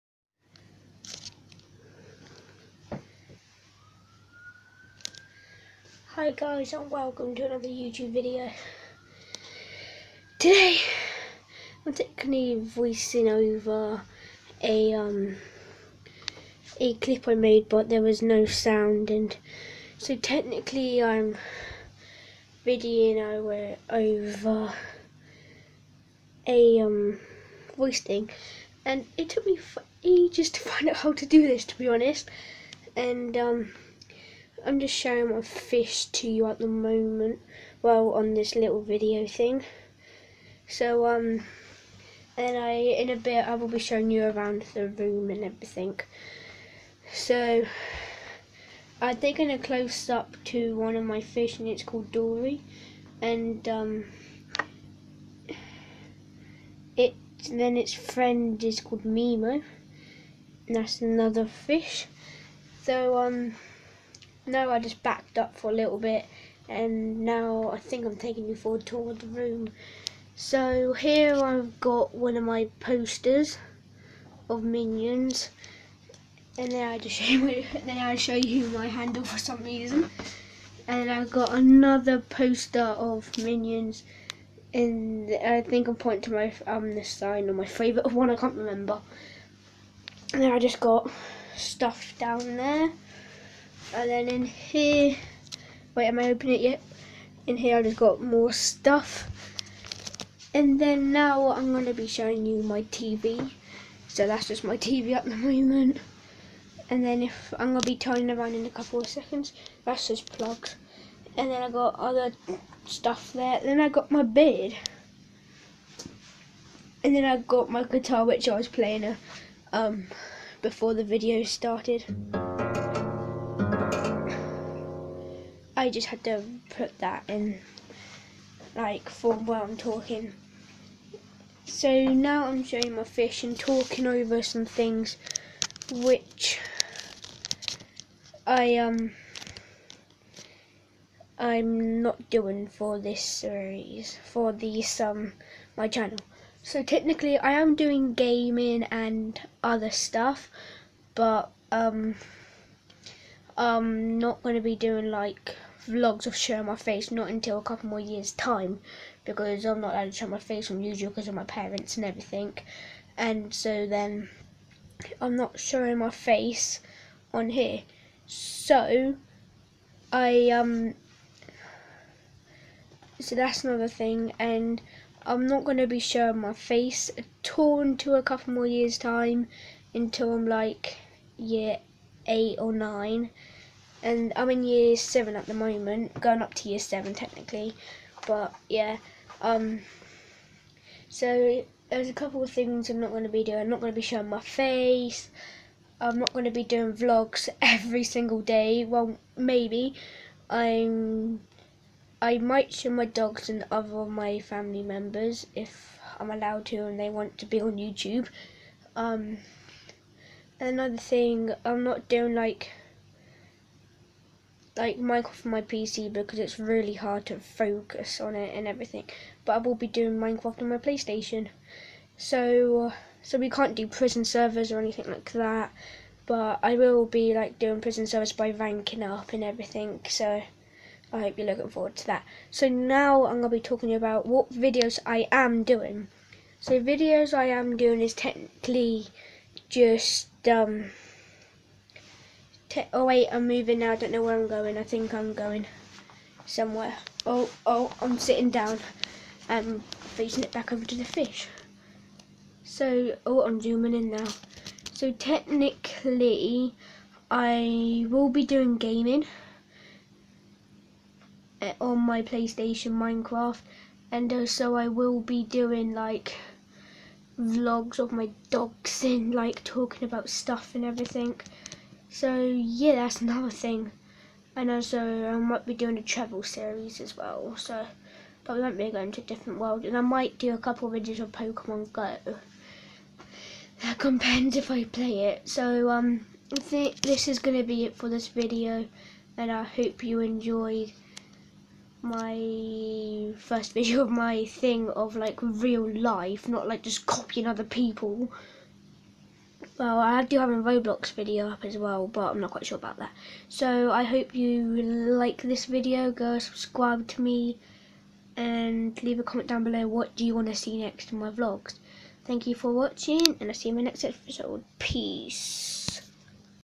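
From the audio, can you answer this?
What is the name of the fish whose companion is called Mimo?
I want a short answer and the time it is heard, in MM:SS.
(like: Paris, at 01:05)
Dory, at 00:52.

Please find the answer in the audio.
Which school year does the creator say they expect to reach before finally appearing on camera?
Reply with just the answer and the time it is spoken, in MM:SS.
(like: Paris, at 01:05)
Year 8 or 9, at 03:01.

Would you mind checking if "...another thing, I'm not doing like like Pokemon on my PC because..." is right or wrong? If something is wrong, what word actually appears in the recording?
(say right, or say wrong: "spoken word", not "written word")
wrong: "Minecraft", not "Pokemon".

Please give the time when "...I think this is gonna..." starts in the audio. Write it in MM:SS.
04:46.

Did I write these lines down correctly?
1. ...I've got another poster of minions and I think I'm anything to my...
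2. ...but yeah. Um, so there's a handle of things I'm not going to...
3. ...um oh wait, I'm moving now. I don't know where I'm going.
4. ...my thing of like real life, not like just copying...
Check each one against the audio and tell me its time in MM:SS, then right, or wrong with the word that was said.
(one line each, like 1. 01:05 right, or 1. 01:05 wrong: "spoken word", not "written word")
1. 01:21 wrong: "pointing", not "anything"
2. 03:08 wrong: "couple", not "handle"
3. 04:00 right
4. 04:54 right.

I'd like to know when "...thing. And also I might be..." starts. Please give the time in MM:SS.
04:33.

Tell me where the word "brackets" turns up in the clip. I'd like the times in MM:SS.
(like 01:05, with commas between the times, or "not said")
not said.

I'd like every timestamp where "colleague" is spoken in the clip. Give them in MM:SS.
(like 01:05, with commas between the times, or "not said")
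not said.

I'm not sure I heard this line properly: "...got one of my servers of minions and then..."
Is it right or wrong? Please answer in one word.
wrong.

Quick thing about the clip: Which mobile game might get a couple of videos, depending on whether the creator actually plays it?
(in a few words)
Pokemon Go.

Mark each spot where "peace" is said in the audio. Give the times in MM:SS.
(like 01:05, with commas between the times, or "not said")
05:14.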